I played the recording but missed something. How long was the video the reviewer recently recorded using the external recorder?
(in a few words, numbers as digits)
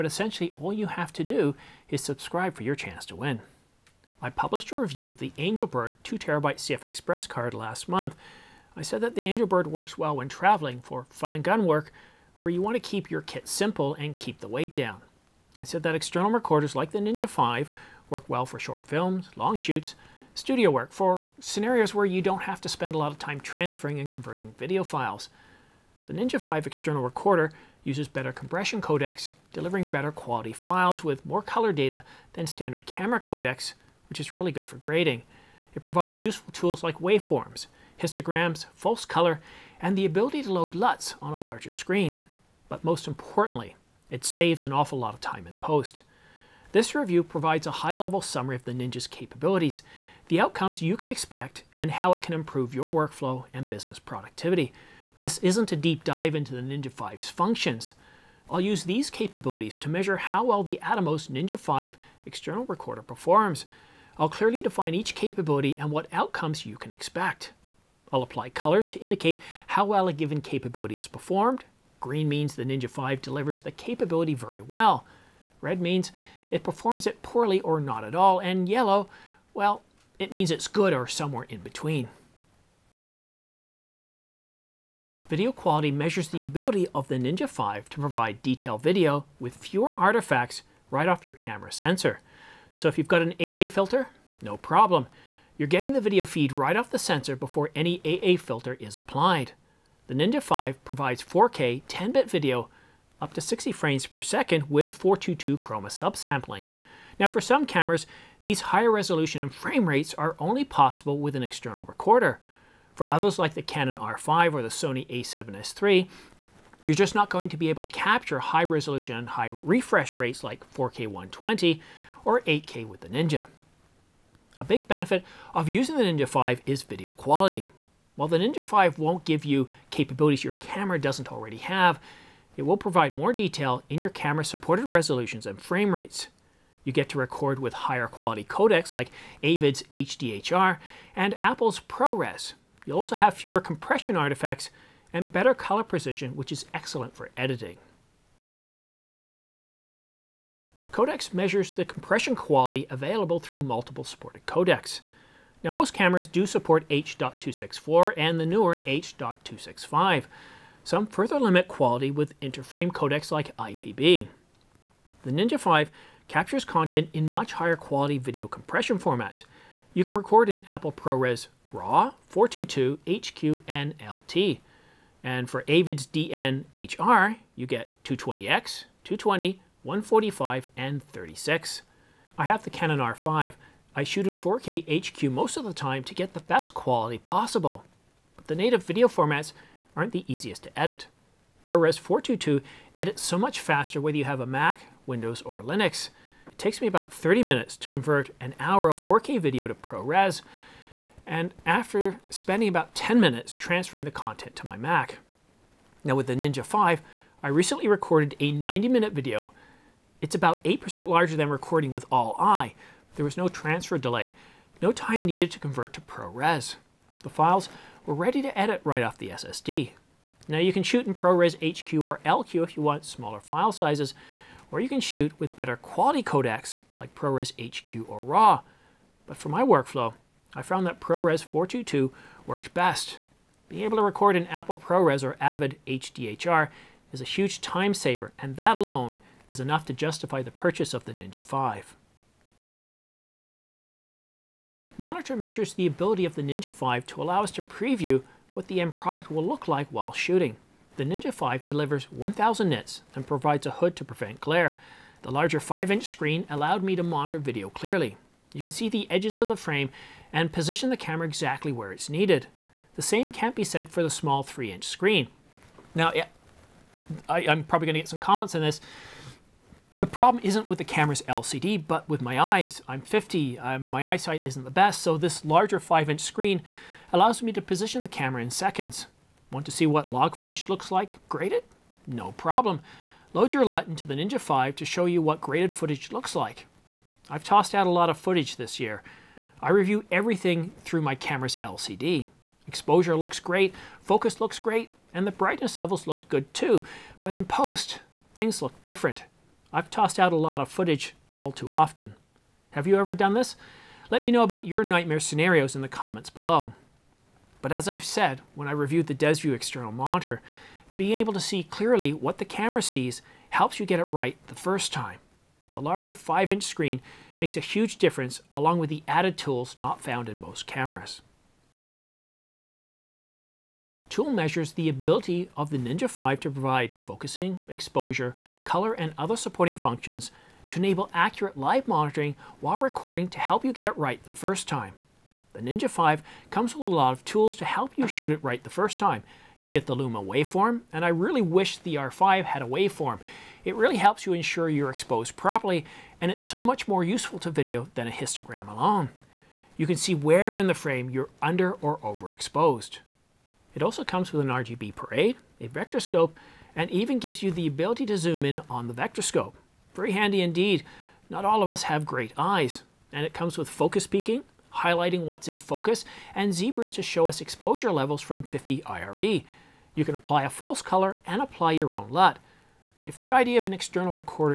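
90 minutes.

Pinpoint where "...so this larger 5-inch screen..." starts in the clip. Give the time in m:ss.
4:35.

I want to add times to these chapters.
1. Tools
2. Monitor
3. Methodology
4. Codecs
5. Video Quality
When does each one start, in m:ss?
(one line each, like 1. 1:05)
1. 5:21
2. 4:02
3. 0:42
4. 2:28
5. 1:22.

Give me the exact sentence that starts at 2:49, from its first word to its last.
You can record in Apple ProRes RAW, 422, HQ, and LT.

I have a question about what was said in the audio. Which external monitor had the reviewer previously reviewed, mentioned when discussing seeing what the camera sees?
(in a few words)
DesView.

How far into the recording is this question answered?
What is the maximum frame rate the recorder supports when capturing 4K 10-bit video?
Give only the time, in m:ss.
1:43.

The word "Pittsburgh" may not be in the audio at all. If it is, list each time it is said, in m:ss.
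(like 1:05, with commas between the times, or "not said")
not said.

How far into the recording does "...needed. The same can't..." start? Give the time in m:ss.
4:22.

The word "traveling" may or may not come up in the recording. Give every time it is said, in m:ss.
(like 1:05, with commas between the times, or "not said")
0:10.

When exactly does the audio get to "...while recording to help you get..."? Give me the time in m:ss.
5:32.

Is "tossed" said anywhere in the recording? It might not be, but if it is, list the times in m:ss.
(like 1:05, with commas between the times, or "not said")
4:47, 4:59.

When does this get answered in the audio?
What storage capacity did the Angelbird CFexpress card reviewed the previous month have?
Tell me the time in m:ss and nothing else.
0:06.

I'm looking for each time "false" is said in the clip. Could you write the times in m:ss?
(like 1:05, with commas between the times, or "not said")
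0:38, 6:10.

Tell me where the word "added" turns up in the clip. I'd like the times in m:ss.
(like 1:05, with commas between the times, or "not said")
5:19.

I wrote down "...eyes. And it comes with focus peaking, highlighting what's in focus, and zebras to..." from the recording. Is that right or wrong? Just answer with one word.
right.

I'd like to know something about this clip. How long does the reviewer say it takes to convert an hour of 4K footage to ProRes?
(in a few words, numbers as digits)
30 minutes.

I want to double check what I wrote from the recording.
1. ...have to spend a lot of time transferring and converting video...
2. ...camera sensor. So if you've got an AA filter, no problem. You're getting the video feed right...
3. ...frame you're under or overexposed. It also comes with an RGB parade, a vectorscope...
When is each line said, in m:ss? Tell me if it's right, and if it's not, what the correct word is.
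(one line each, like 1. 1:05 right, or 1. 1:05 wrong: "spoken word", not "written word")
1. 0:22 right
2. 1:31 right
3. 5:50 right.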